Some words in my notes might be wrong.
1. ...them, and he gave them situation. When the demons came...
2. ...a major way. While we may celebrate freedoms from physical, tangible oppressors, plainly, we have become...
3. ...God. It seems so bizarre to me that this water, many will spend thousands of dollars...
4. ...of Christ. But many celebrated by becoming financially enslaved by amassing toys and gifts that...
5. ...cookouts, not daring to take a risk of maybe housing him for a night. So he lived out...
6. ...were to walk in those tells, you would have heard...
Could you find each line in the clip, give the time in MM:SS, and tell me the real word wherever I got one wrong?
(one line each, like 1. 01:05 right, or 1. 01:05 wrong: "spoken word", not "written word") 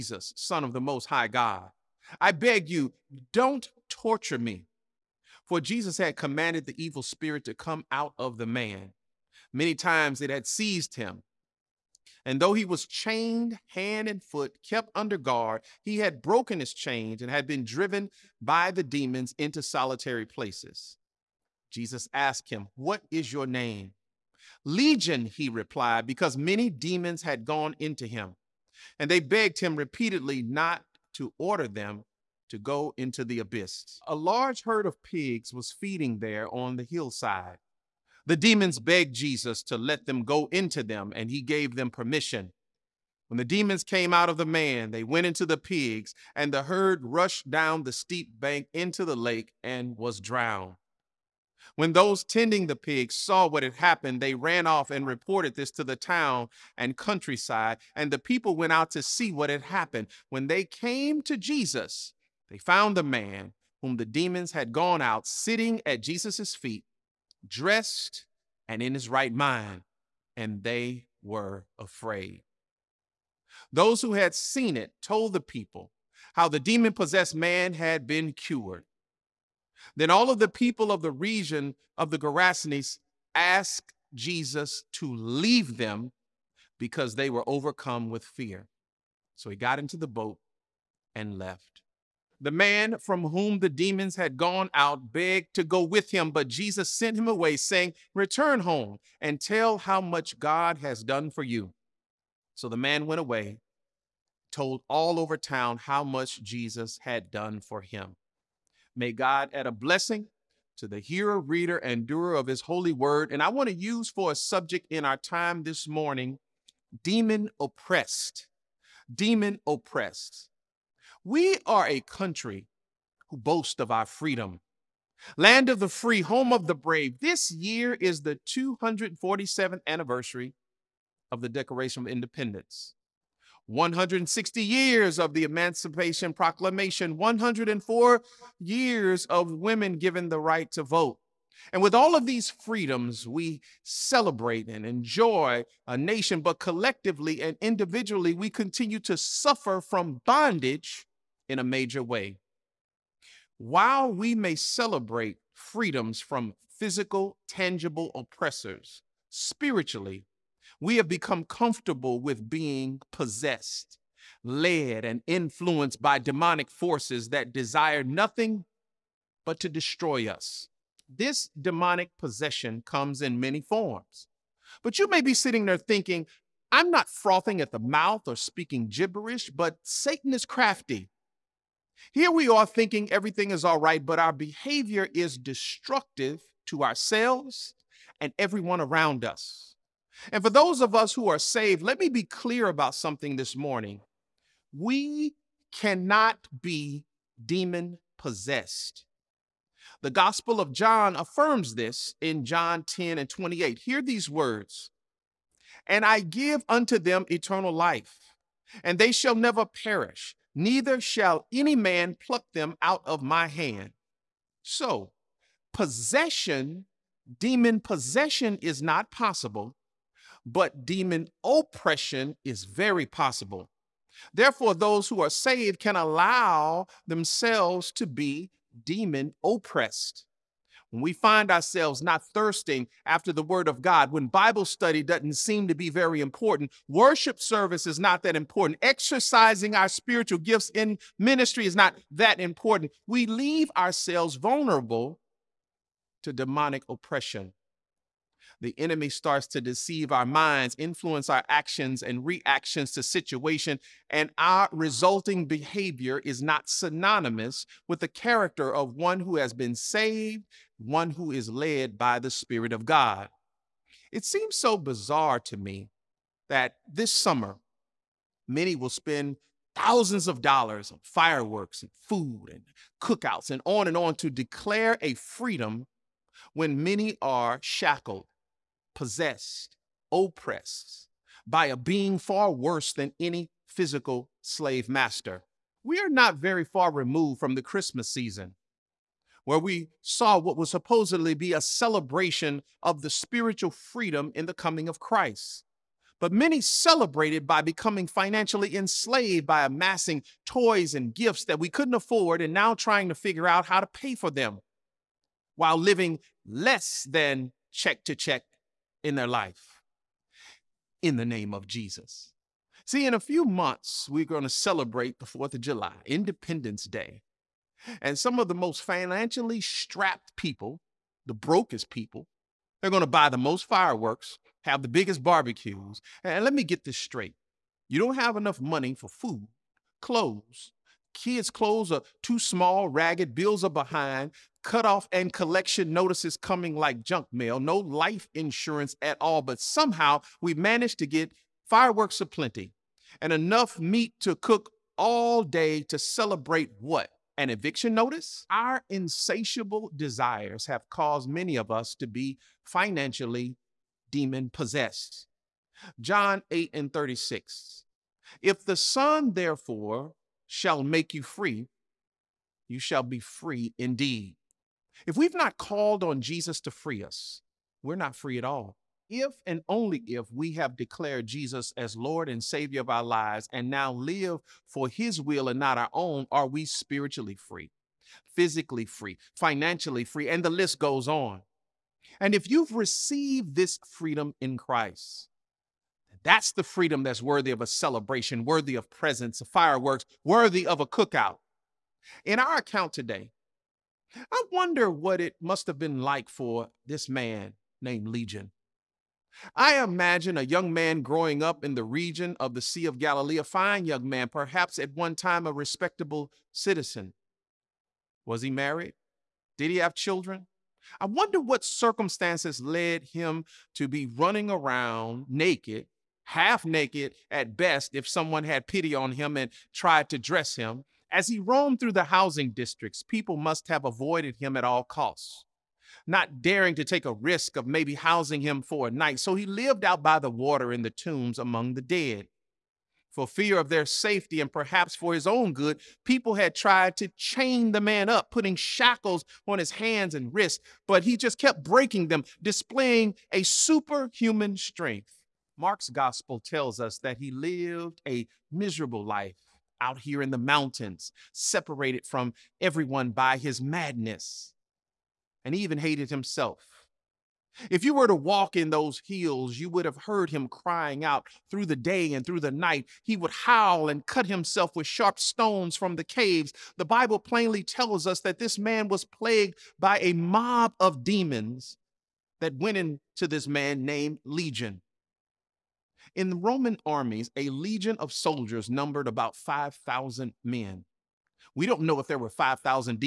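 1. 00:40 wrong: "permission", not "situation"
2. 02:31 wrong: "spiritually", not "plainly"
3. 04:22 wrong: "summer", not "water"
4. 04:54 right
5. 07:04 wrong: "costs", not "cookouts"
6. 07:37 wrong: "hills", not "tells".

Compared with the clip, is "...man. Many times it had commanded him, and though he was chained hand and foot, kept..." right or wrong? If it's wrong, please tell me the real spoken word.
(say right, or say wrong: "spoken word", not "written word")
wrong: "seized", not "commanded".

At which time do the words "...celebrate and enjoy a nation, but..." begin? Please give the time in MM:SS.
02:23.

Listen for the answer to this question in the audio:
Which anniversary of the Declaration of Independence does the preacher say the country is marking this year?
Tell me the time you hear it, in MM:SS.
02:08.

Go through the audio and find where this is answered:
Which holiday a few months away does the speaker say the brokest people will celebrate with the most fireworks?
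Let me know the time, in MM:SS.
05:15.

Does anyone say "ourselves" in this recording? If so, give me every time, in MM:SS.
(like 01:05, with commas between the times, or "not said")
03:06, 03:51, 04:03.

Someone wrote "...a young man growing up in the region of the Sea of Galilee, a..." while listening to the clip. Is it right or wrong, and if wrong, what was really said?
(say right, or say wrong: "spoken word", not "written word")
right.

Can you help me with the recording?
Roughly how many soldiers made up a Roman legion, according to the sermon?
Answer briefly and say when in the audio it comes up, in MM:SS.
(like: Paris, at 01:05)
5,000, at 07:59.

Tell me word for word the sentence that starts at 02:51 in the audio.
This demonic possession comes in many forms.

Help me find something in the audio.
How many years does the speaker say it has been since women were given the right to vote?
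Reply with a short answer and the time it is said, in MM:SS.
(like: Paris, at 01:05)
104, at 02:17.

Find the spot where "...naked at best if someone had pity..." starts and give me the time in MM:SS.
06:56.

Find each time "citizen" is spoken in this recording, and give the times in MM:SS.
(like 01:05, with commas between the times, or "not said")
06:46.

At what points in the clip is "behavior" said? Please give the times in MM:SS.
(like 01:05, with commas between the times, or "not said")
03:04, 04:15.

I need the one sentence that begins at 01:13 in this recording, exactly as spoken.
Those who had seen it told the people how the demon possessed man had been cured.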